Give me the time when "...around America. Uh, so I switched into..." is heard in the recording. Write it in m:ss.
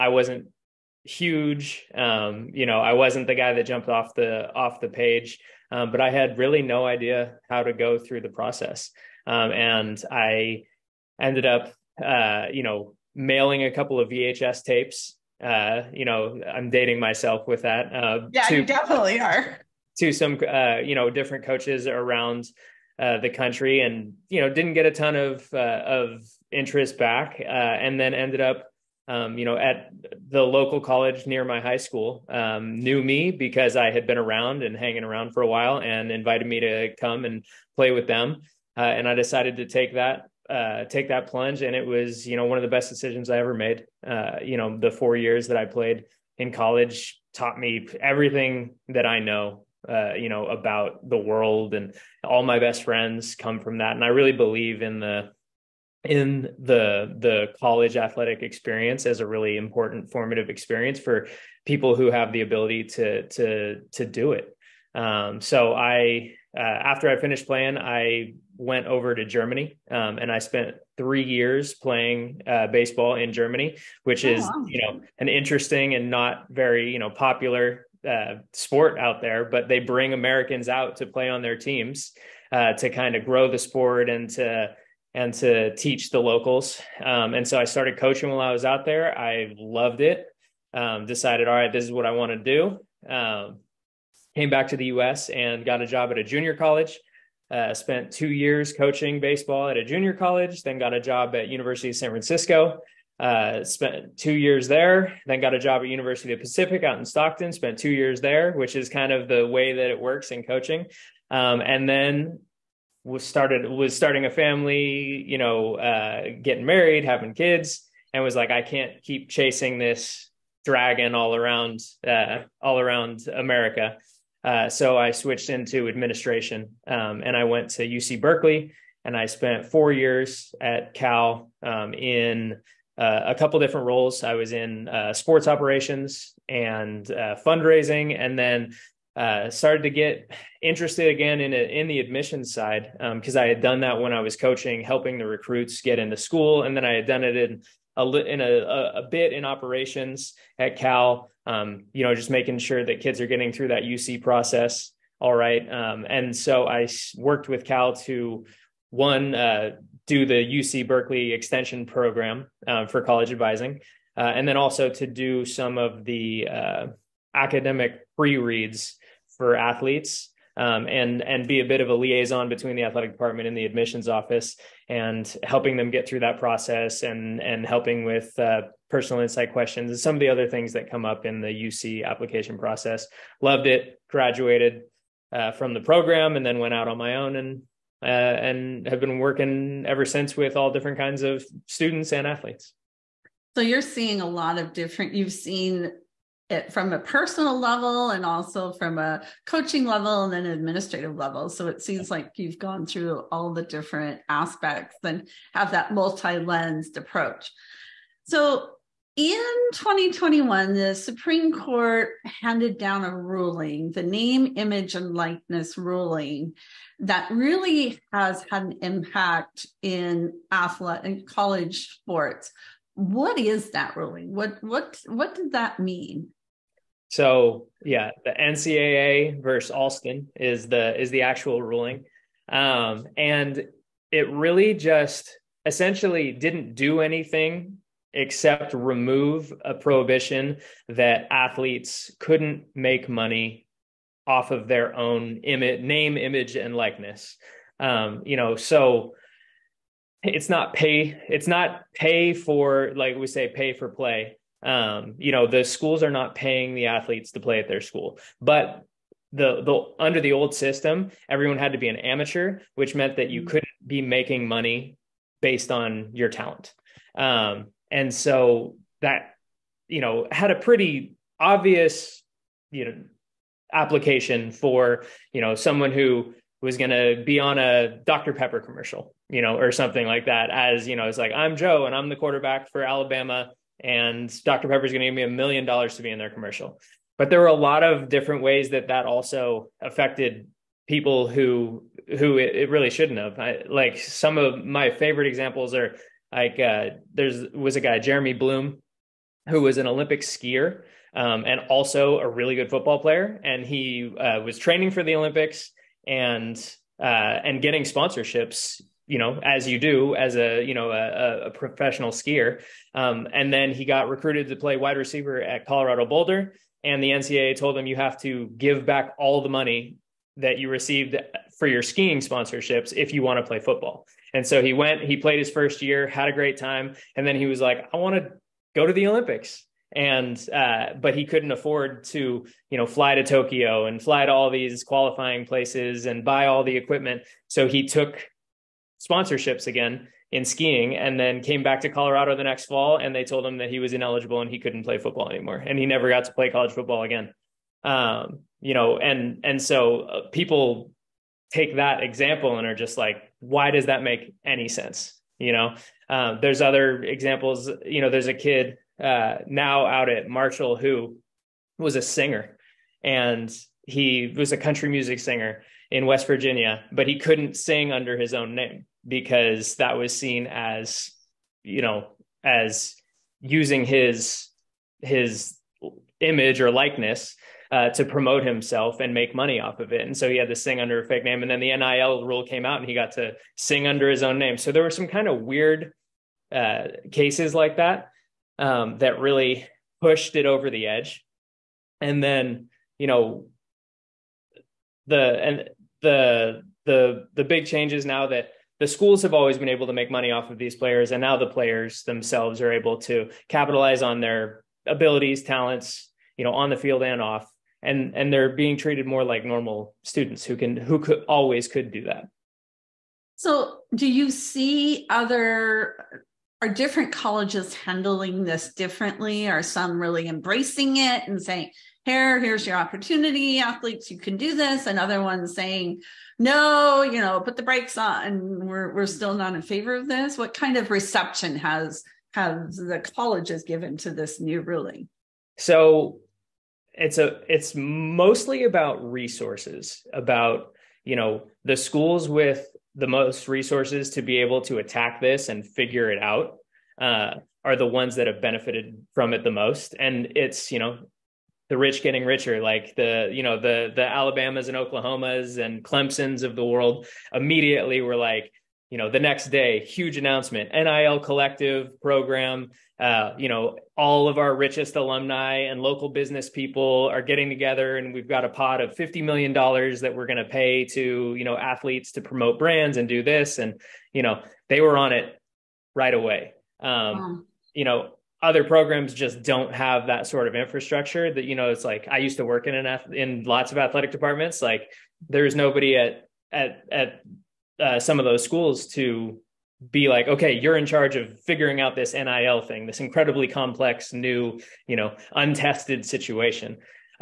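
2:02.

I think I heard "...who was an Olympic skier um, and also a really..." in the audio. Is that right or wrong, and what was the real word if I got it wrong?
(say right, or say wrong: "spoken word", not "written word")
right.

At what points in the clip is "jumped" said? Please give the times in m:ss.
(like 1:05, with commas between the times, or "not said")
0:03.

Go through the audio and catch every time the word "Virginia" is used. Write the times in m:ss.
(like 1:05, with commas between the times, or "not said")
6:06.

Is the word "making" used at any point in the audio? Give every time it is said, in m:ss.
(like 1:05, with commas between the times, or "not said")
2:32, 4:24.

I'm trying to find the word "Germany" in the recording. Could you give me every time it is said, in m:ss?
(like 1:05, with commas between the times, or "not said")
1:09, 1:13.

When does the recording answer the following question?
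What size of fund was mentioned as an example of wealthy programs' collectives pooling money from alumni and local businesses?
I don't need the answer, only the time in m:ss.
7:48.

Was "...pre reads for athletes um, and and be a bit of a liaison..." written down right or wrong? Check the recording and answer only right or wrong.
right.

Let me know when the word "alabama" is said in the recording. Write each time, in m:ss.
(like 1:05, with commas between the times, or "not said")
4:42, 7:34.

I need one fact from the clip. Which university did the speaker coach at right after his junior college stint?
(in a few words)
University of San Francisco.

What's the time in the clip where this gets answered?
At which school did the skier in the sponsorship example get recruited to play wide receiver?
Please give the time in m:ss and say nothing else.
5:15.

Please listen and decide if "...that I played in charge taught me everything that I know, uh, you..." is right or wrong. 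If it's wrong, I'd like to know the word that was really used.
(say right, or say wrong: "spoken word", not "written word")
wrong: "college", not "charge".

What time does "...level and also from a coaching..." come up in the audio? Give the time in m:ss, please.
3:17.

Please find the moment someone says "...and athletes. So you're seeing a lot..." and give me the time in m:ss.
3:12.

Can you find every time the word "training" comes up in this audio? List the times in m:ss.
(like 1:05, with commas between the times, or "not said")
5:04.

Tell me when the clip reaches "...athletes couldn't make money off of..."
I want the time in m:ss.
4:01.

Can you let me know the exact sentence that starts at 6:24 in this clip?
So there were some kind of weird uh, cases like that um, that really pushed it over the edge.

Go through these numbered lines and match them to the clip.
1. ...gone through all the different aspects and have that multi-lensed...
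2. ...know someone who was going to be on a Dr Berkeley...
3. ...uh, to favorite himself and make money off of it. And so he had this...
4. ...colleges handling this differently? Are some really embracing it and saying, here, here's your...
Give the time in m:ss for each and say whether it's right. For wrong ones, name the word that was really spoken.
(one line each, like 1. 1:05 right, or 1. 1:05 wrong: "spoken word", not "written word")
1. 3:22 right
2. 4:35 wrong: "Pepper", not "Berkeley"
3. 6:17 wrong: "promote", not "favorite"
4. 6:57 right.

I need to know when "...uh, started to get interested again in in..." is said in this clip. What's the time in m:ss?
2:19.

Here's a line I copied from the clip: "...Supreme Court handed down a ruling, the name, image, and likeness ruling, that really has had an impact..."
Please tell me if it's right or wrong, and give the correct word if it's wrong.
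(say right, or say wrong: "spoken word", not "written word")
right.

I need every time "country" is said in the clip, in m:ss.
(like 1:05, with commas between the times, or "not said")
0:23, 6:04.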